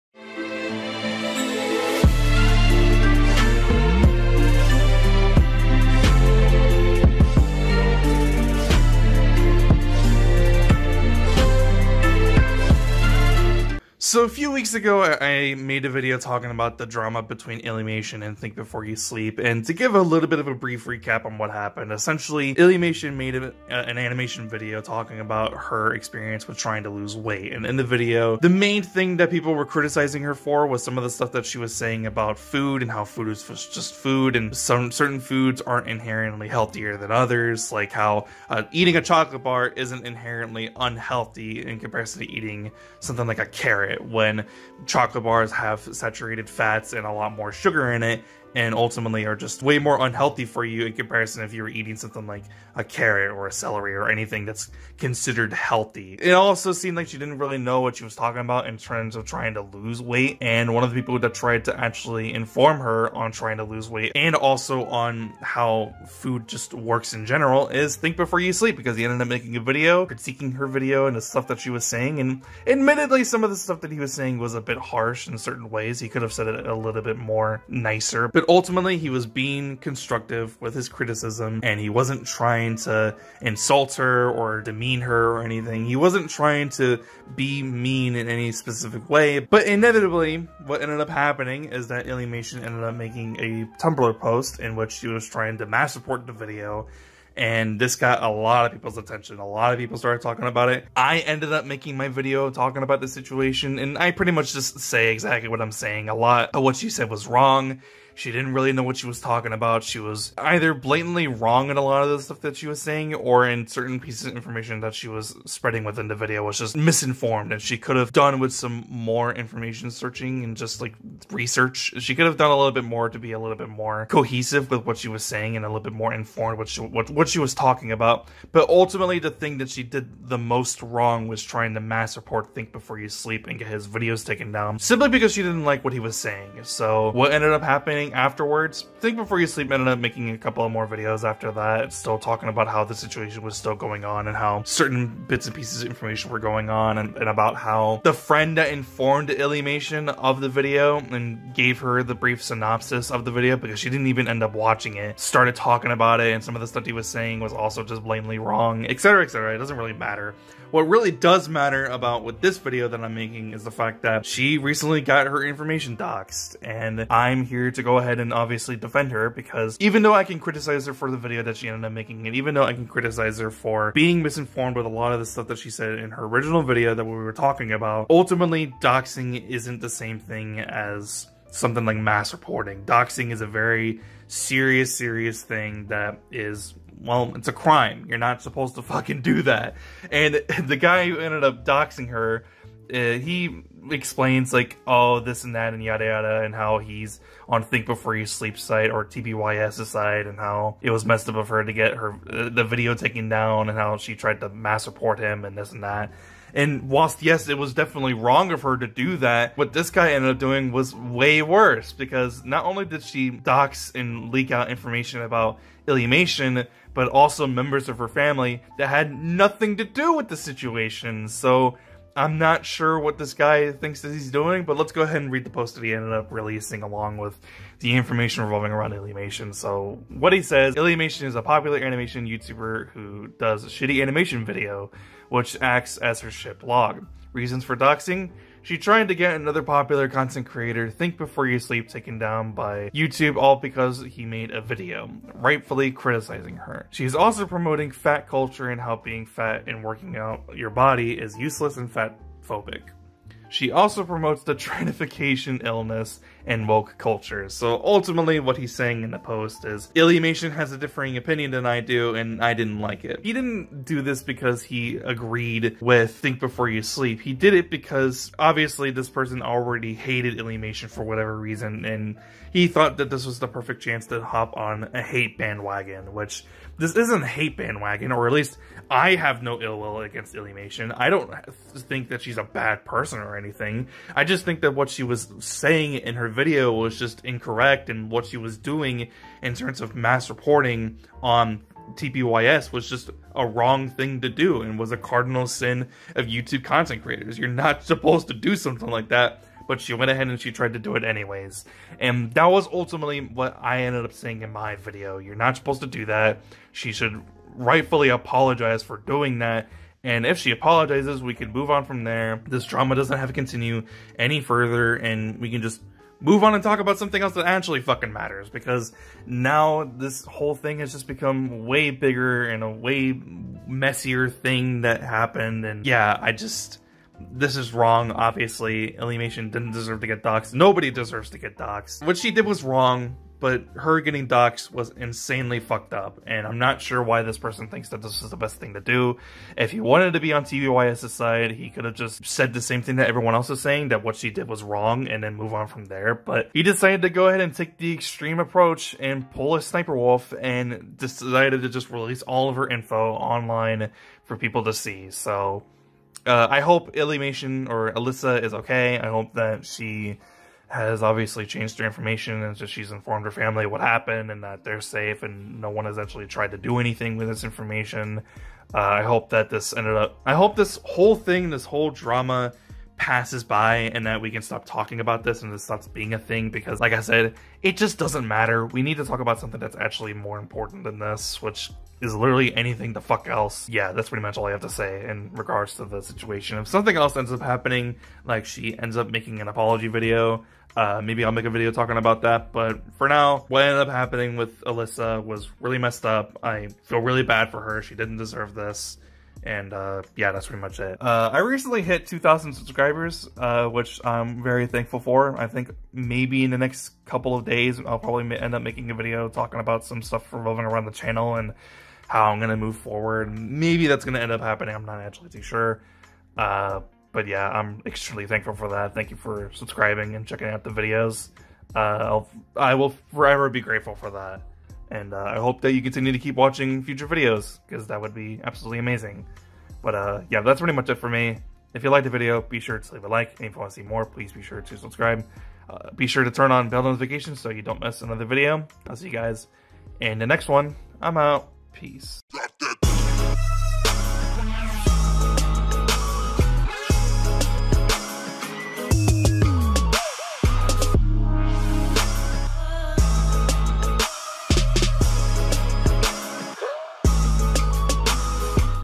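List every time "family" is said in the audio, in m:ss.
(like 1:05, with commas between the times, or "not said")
3:38, 6:03.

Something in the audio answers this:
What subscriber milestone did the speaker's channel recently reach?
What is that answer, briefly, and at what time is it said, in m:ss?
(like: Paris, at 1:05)
2,000, at 6:42.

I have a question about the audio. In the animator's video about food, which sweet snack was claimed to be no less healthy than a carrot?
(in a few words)
chocolate bar.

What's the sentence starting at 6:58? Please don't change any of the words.
Thank you for subscribing and checking out the videos.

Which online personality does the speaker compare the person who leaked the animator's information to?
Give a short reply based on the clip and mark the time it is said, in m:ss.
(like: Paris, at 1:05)
Sniper Wolf, at 5:49.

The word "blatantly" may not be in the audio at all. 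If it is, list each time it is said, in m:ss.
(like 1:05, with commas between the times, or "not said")
1:50, 2:38.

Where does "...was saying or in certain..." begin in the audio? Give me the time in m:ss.
1:52.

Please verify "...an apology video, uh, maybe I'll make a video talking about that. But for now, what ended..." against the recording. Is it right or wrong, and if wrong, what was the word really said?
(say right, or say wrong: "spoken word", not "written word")
right.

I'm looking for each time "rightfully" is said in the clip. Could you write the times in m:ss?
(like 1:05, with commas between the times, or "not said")
4:05, 5:07.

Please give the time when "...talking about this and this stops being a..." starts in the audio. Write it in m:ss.
6:14.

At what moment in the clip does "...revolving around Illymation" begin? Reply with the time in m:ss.
3:48.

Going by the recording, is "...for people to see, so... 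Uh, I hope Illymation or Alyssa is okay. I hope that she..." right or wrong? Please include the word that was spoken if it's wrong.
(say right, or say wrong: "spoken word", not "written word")
right.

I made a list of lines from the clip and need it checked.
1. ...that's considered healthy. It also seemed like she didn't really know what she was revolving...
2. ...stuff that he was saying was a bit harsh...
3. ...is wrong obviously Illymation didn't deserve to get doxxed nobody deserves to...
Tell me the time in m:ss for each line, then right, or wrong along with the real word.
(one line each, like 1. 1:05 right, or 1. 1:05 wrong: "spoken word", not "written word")
1. 0:54 wrong: "talking", not "revolving"
2. 1:13 right
3. 5:27 right.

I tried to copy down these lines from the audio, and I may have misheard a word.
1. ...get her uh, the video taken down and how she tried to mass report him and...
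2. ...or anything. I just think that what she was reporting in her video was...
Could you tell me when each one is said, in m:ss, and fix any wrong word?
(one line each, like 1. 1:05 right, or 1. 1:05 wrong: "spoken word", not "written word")
1. 3:21 right
2. 4:43 wrong: "saying", not "reporting".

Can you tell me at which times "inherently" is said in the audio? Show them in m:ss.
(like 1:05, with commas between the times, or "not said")
0:35, 0:40.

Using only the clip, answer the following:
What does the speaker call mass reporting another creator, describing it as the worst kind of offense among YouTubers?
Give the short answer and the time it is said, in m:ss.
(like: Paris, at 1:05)
cardinal sin, at 4:54.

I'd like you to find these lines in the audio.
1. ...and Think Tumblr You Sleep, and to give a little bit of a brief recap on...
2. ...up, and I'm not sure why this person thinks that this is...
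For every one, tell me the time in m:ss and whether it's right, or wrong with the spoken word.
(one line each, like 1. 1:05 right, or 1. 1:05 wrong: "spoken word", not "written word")
1. 0:18 wrong: "Before", not "Tumblr"
2. 5:35 right.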